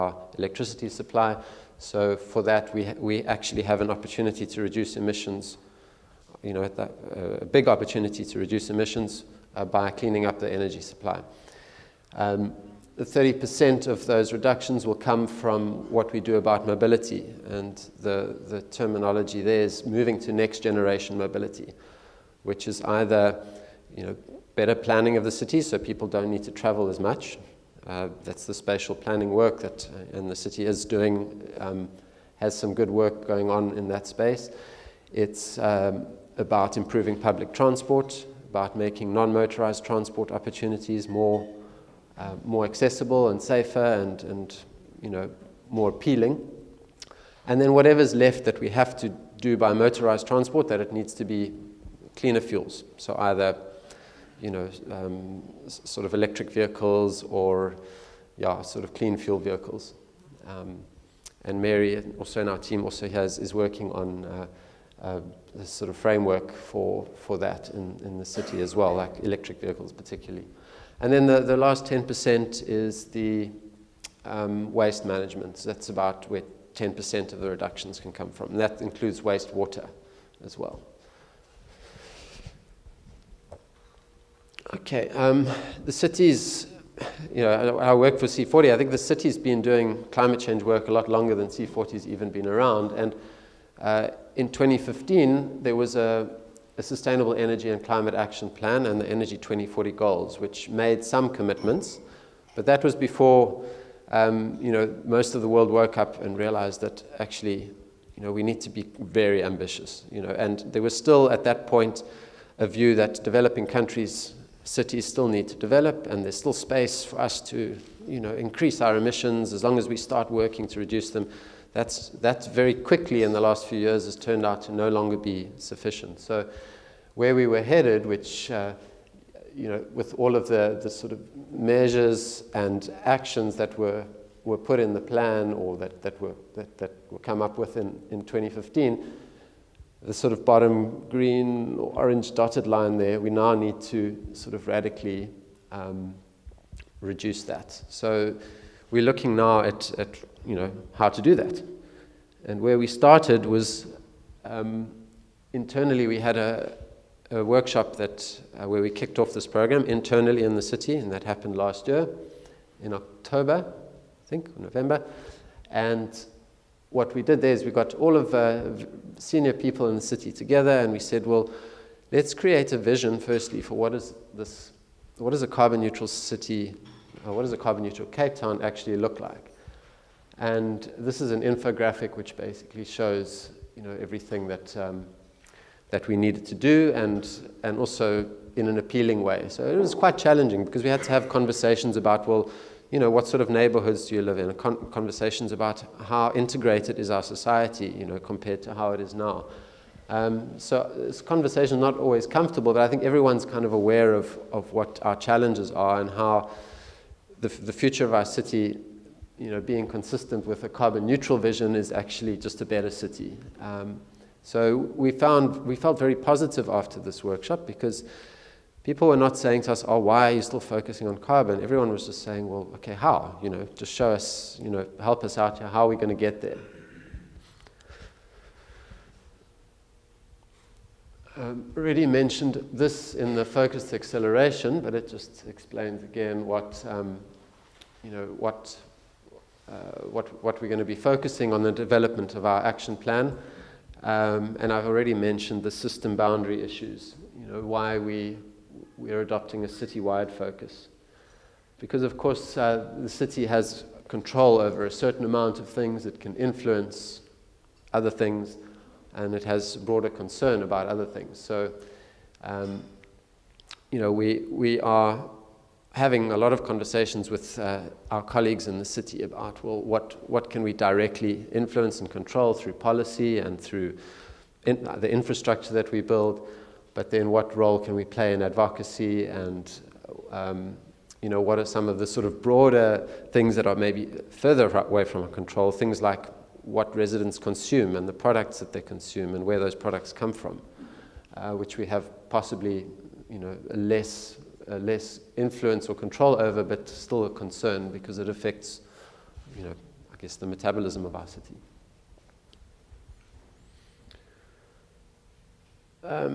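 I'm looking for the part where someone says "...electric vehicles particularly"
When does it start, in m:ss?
1:09.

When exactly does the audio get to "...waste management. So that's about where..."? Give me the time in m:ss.
1:14.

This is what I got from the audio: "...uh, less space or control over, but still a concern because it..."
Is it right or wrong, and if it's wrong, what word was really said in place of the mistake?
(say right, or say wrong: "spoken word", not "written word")
wrong: "influence", not "space".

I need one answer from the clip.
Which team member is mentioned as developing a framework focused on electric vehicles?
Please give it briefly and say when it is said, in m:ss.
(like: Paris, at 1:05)
Mary, at 1:01.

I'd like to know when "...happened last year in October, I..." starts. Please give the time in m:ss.
2:41.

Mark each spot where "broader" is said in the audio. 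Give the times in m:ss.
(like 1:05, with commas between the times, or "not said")
4:19, 4:42.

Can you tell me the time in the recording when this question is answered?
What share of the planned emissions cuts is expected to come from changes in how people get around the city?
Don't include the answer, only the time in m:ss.
0:13.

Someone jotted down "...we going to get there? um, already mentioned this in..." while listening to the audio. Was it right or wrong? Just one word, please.
right.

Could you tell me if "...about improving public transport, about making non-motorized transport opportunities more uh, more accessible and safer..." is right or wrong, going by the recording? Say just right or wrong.
right.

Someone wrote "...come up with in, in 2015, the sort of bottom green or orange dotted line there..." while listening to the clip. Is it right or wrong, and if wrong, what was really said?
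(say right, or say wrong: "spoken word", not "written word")
right.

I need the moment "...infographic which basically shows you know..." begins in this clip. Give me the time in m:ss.
3:01.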